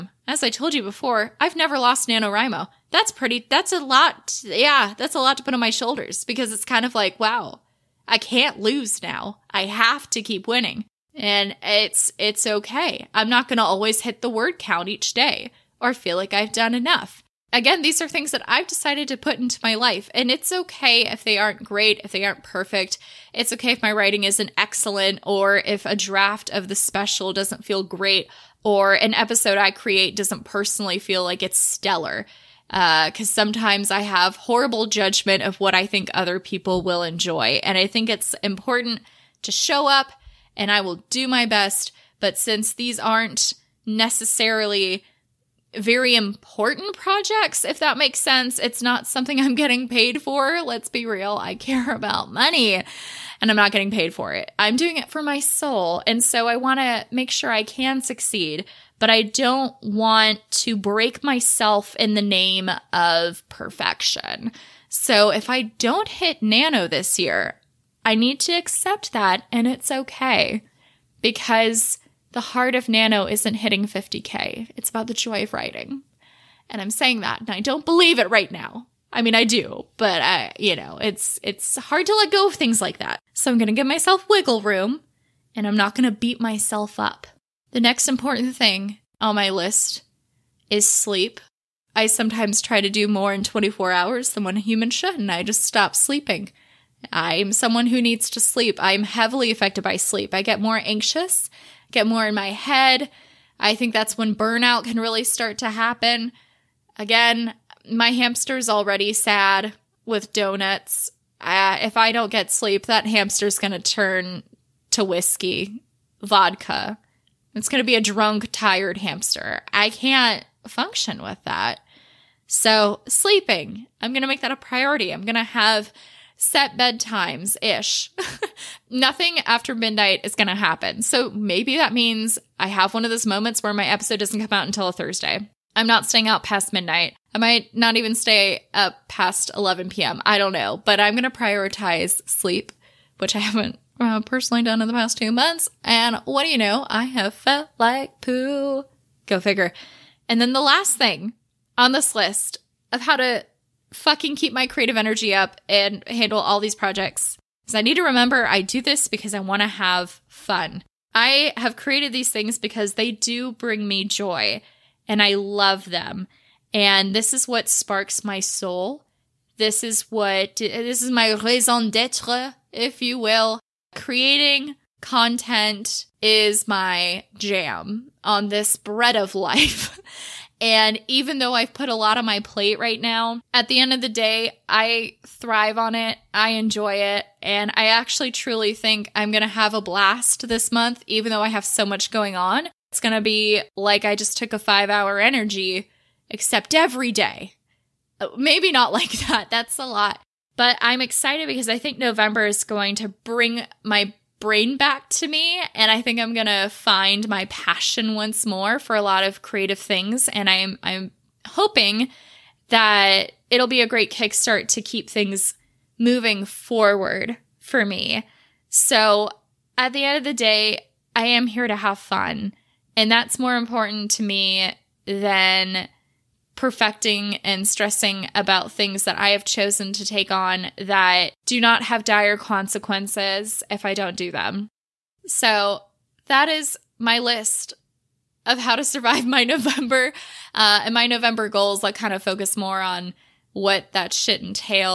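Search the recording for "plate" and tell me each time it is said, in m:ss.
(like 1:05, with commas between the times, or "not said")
3:02.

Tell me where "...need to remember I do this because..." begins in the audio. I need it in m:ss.
2:37.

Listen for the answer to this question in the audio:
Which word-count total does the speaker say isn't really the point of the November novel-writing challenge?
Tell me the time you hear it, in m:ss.
1:13.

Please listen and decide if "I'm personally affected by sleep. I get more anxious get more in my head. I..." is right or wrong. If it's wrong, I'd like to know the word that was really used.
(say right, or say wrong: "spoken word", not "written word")
wrong: "heavily", not "personally".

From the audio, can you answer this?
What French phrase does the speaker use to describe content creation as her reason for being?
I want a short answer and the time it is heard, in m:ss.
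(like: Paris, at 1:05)
raison d'etre, at 2:51.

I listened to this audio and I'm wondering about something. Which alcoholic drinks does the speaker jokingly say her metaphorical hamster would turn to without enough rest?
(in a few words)
whiskey, vodka.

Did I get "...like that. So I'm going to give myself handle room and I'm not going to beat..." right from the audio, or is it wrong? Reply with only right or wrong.
wrong.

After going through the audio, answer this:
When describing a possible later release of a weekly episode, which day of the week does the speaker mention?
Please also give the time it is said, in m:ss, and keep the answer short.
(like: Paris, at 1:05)
Thursday, at 2:14.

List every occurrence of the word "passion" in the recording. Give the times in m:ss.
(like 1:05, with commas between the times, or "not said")
3:27.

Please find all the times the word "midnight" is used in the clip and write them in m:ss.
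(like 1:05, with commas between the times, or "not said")
2:09, 2:16.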